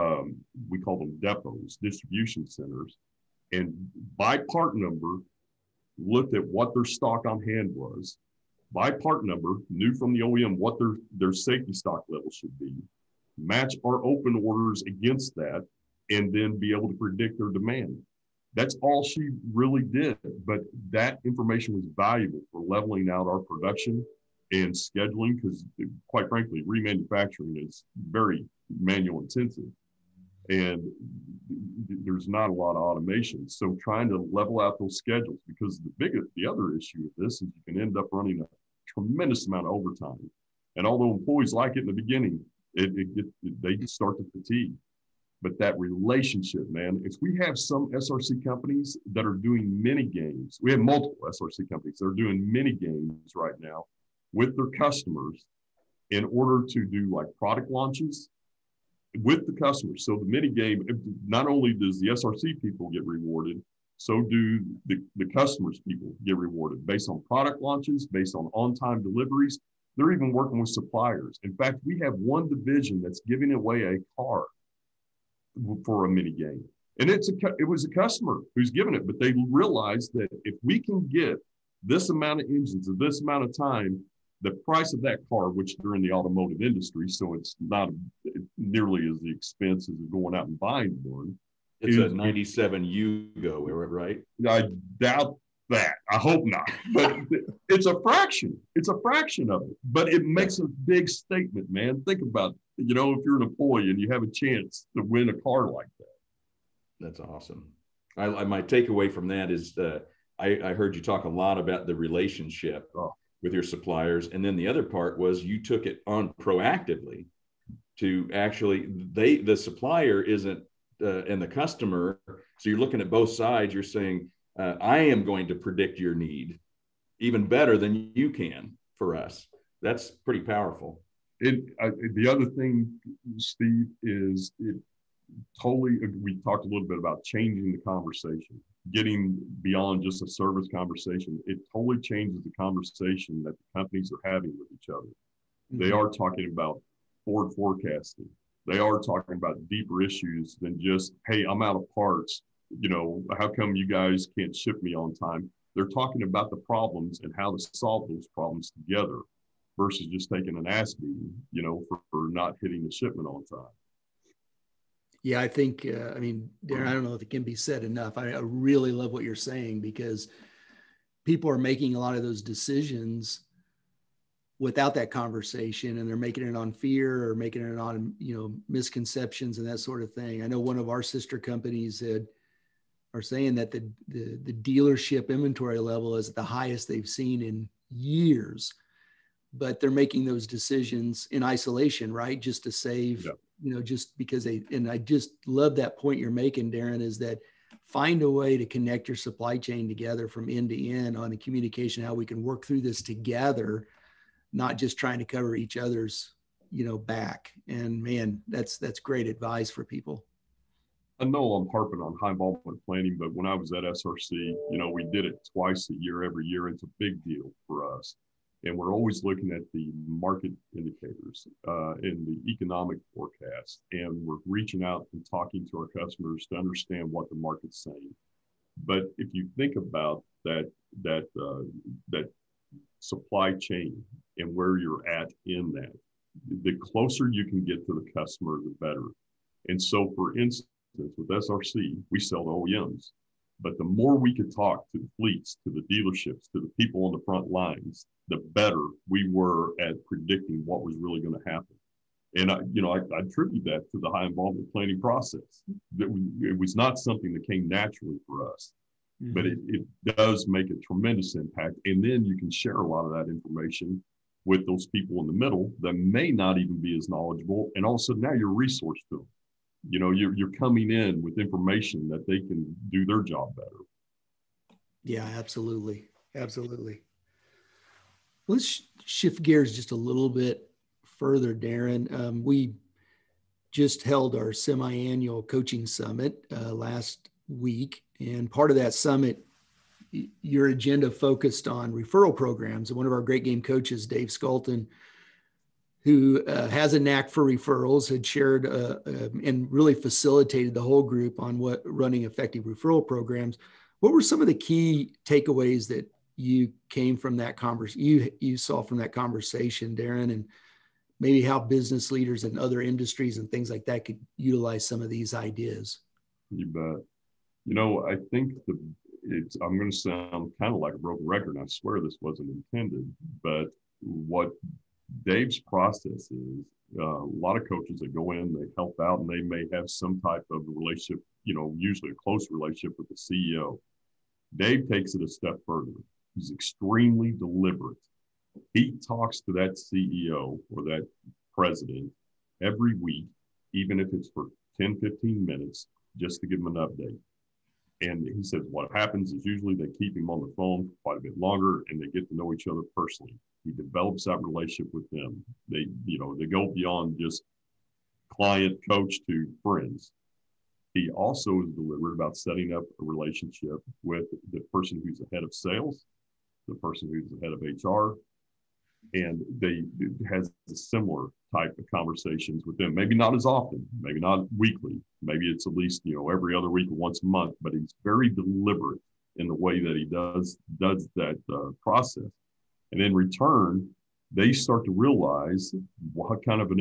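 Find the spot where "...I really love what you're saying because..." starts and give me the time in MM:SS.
02:48.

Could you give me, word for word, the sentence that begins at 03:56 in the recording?
The closer you can get to the customer, the better.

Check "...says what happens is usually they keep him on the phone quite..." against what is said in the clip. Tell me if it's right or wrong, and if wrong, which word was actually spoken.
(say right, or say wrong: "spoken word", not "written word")
right.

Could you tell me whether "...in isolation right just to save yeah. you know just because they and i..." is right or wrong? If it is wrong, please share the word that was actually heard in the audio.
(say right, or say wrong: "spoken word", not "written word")
right.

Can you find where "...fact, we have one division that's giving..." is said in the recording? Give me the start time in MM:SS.
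01:11.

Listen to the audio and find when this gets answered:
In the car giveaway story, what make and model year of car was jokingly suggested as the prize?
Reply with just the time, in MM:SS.
01:32.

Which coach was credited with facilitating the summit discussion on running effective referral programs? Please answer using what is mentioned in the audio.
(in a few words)
Dave Sculton.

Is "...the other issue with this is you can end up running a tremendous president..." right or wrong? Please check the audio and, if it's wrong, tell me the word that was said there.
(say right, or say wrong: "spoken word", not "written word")
wrong: "amount", not "president".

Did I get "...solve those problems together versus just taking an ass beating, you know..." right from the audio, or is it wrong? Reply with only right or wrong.
right.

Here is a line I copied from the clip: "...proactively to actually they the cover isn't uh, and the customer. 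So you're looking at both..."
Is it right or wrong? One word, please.
wrong.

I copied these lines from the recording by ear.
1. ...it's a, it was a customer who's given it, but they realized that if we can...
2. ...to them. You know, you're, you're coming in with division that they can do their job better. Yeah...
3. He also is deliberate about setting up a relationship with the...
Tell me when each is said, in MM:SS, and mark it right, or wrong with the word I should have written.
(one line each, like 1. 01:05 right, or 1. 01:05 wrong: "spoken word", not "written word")
1. 01:17 right
2. 04:29 wrong: "information", not "division"
3. 06:00 right.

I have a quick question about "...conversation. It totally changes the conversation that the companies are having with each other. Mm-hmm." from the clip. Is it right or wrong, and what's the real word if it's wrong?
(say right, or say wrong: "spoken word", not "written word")
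right.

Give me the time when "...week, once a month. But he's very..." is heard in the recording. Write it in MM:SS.
06:16.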